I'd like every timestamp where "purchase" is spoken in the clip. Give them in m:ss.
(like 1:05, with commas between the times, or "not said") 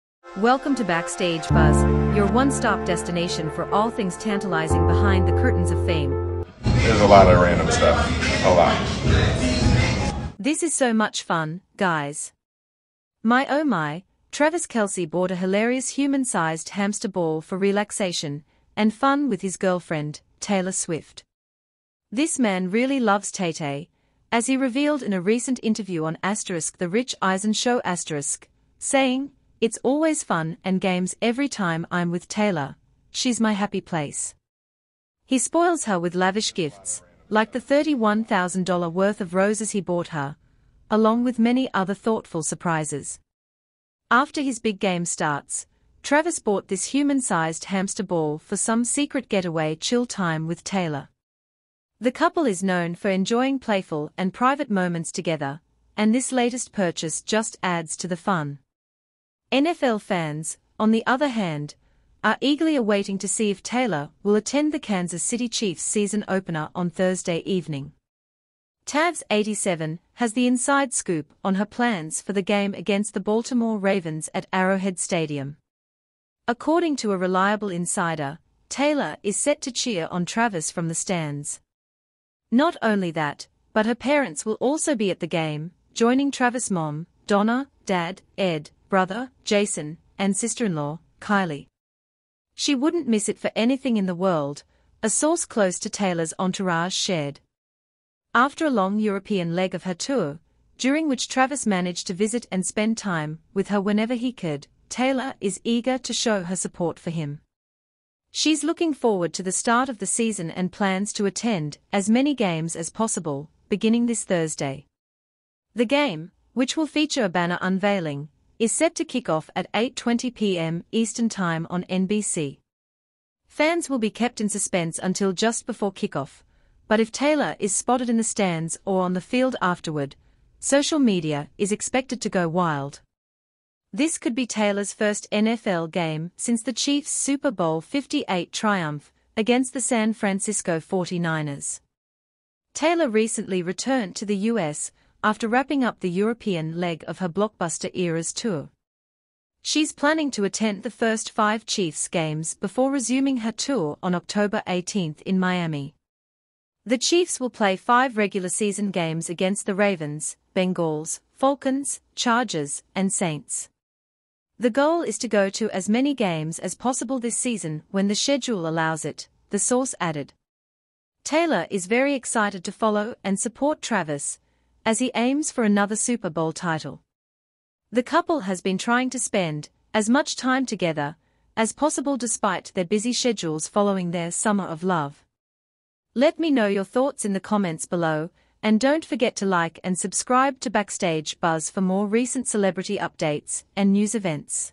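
0:56.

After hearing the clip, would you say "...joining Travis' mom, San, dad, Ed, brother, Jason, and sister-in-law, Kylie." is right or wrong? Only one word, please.
wrong.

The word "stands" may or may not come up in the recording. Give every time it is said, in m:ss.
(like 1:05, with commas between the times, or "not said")
1:20, 2:08.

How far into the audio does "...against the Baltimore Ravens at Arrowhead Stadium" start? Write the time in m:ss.
1:12.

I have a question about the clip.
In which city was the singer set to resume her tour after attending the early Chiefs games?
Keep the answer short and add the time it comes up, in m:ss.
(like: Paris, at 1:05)
Miami, at 2:35.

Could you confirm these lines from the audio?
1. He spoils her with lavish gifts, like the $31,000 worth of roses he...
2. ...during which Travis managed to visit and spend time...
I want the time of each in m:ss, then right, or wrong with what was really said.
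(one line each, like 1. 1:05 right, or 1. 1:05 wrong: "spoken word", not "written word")
1. 0:35 right
2. 1:40 right.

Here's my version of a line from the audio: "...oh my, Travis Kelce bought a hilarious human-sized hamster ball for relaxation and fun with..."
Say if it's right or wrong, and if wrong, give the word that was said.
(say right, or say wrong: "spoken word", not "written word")
right.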